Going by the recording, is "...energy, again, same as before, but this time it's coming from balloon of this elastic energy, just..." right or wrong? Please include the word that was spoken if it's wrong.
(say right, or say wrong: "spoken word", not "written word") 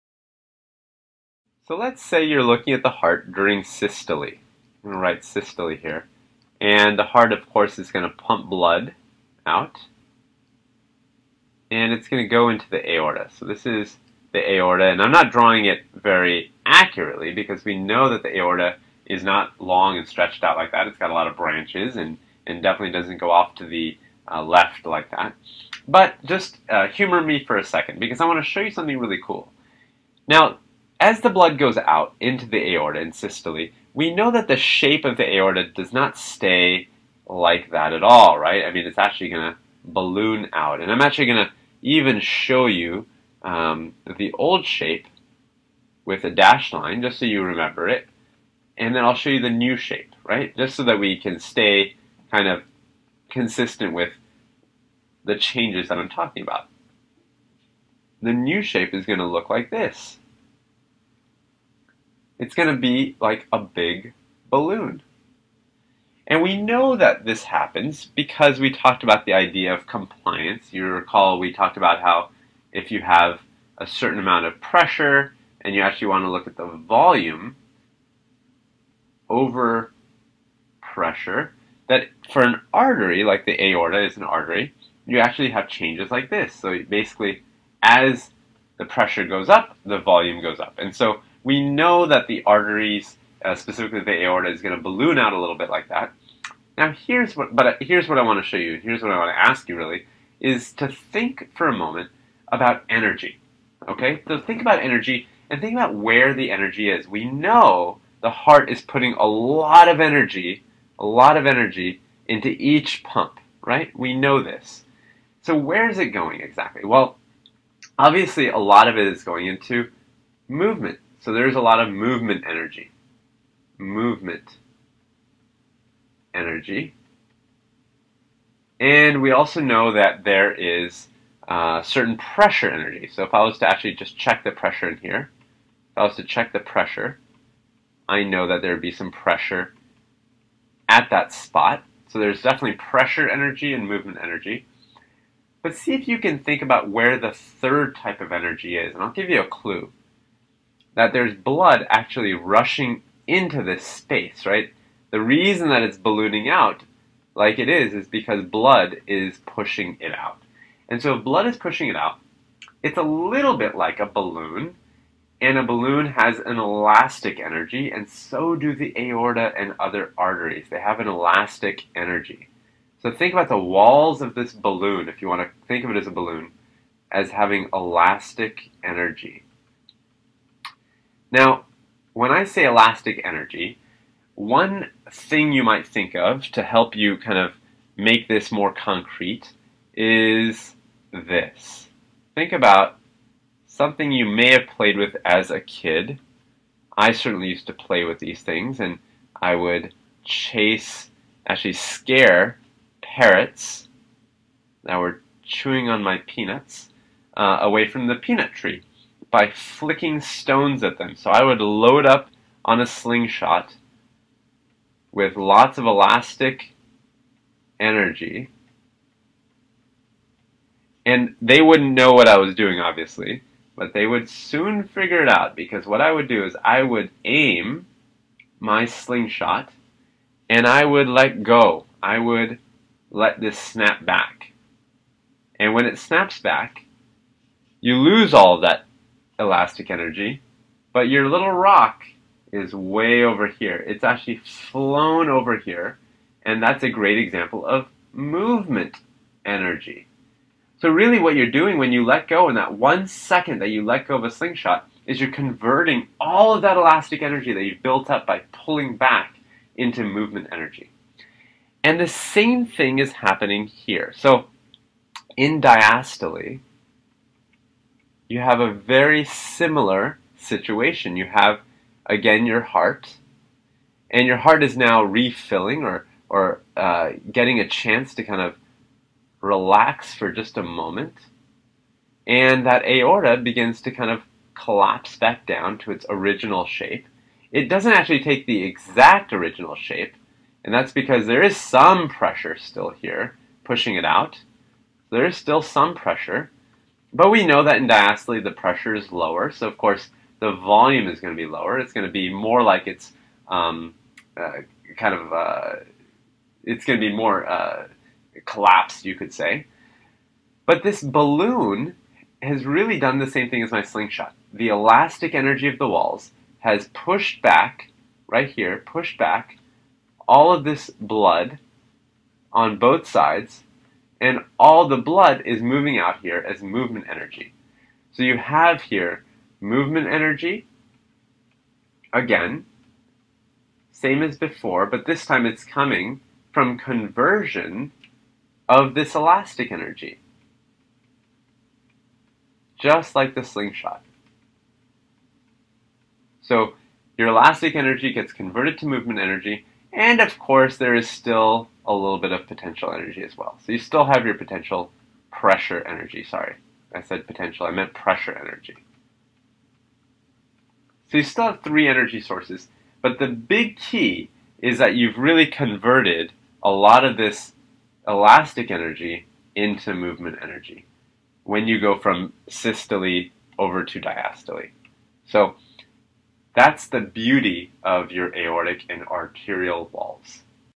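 wrong: "conversion", not "balloon".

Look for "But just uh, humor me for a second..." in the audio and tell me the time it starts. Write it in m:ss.
0:25.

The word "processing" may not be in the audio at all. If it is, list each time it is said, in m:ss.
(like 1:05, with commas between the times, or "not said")
not said.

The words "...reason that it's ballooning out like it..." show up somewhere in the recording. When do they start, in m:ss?
2:35.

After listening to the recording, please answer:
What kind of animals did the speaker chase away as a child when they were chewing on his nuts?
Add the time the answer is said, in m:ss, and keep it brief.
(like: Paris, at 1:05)
parrots, at 3:23.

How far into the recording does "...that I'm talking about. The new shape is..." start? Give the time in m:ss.
0:55.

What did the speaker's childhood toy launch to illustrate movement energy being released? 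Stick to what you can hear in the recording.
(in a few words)
little rock.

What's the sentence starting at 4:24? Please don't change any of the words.
So in diastole, you have a very similar situation.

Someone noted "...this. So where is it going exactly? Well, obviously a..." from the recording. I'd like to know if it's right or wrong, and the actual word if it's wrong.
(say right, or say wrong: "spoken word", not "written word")
right.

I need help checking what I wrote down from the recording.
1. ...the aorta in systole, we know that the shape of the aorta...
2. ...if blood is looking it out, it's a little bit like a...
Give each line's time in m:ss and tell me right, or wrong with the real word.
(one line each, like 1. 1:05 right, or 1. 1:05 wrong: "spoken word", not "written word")
1. 0:32 right
2. 2:41 wrong: "pushing", not "looking".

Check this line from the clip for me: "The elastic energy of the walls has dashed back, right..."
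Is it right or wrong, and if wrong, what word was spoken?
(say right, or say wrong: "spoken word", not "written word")
wrong: "pushed", not "dashed".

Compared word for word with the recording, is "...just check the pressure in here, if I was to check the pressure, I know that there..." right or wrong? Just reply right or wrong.
right.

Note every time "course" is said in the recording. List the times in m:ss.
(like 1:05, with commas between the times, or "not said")
0:07, 4:59, 5:50.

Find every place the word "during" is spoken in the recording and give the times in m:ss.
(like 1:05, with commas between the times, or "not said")
0:03.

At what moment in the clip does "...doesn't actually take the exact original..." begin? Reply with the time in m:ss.
4:47.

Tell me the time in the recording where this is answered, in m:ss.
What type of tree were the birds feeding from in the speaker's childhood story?
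3:28.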